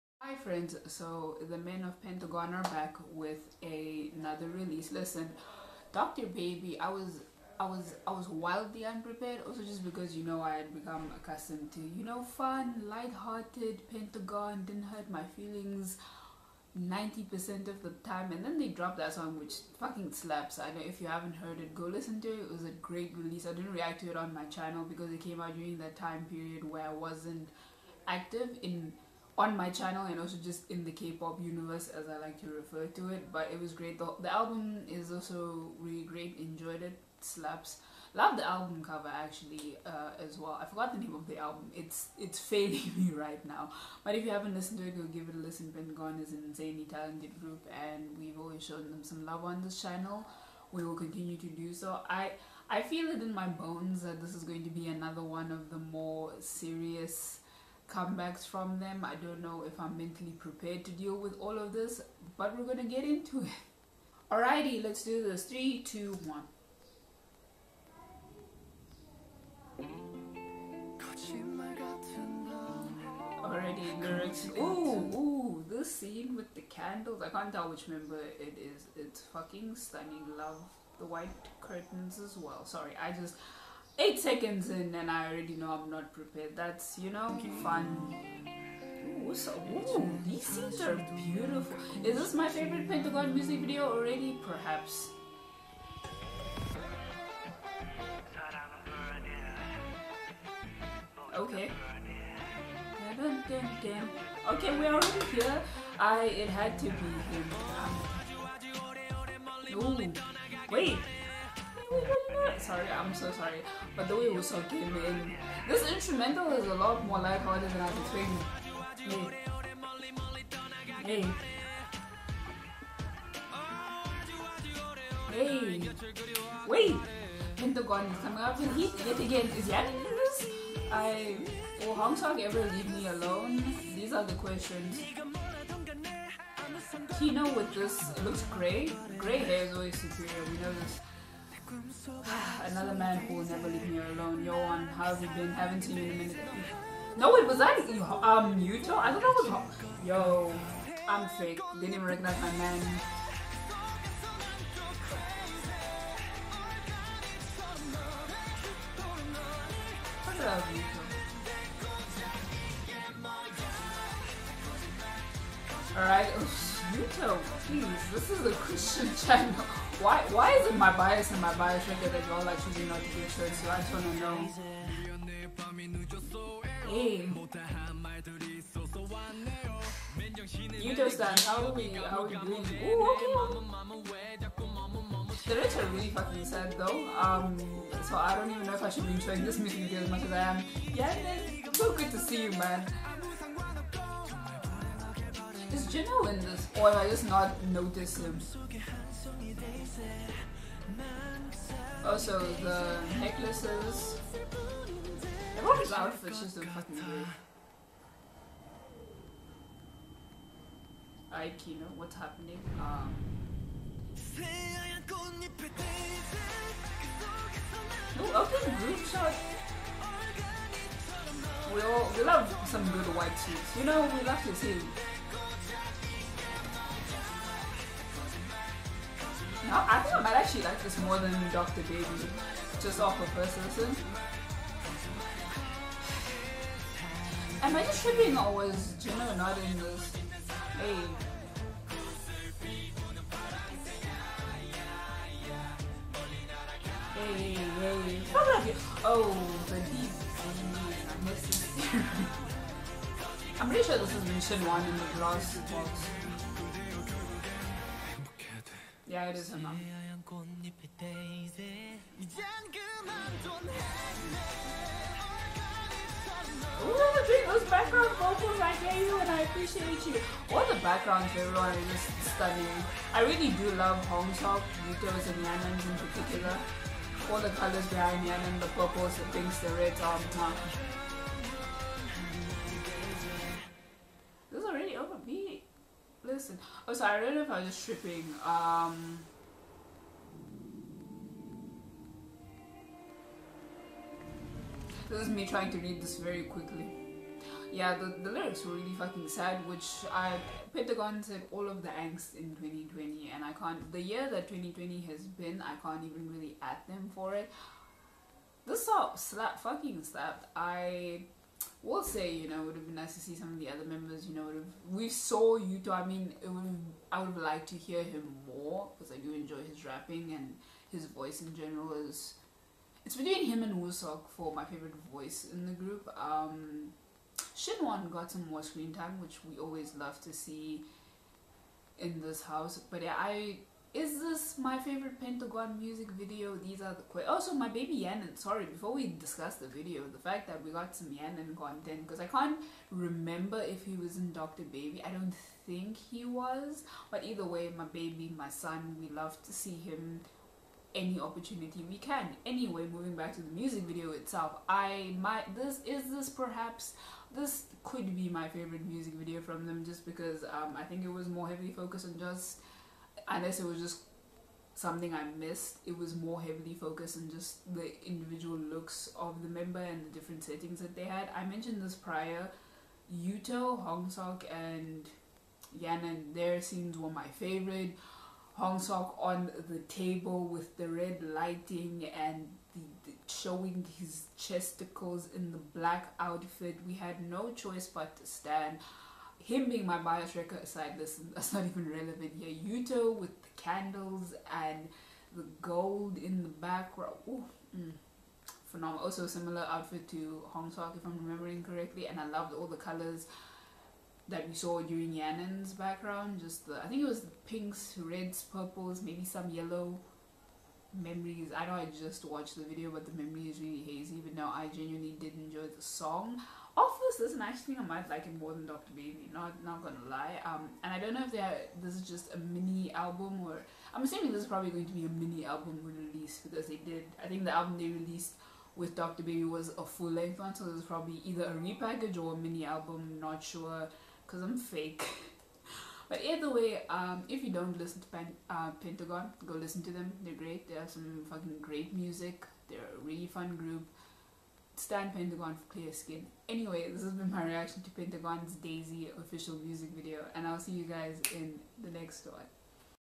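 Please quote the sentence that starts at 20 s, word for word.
I know if you haven't heard it go listen to it.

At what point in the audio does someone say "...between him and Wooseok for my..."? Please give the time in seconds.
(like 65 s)
323 s.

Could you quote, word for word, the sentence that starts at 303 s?
The year that 2020 has been, I can't even really at them for it.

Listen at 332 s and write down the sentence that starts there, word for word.
But yeah, I is this my favorite Pentagon music video?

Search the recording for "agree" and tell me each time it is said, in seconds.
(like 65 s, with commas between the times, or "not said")
206 s.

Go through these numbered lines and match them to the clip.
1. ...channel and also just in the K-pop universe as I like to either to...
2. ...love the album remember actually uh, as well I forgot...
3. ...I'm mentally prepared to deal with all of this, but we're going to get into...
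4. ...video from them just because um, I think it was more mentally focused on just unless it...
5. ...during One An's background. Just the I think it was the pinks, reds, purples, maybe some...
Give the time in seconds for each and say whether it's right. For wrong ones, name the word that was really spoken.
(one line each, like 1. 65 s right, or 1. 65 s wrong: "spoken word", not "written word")
1. 29 s wrong: "refer", not "either"
2. 38 s wrong: "cover", not "remember"
3. 59 s right
4. 359 s wrong: "heavily", not "mentally"
5. 404 s wrong: "Yan", not "One".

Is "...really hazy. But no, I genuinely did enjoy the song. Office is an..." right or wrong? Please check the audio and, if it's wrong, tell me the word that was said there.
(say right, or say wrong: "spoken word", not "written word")
right.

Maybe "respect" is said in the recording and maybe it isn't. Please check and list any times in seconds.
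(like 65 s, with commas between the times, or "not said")
not said.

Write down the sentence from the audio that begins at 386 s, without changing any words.
We had no choice but to stand him being my bias record aside, this that's not even relevant here.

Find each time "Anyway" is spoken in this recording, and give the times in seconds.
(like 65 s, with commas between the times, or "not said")
352 s, 446 s.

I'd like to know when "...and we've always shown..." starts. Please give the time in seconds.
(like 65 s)
47 s.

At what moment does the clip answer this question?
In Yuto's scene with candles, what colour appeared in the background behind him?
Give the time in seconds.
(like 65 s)
395 s.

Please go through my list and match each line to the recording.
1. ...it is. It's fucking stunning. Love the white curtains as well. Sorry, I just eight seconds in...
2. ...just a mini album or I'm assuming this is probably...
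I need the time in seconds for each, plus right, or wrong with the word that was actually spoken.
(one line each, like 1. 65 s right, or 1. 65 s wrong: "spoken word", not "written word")
1. 78 s right
2. 422 s right.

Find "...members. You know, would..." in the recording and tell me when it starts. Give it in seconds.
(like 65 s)
313 s.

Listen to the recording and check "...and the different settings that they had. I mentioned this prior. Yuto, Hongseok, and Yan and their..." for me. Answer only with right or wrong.
right.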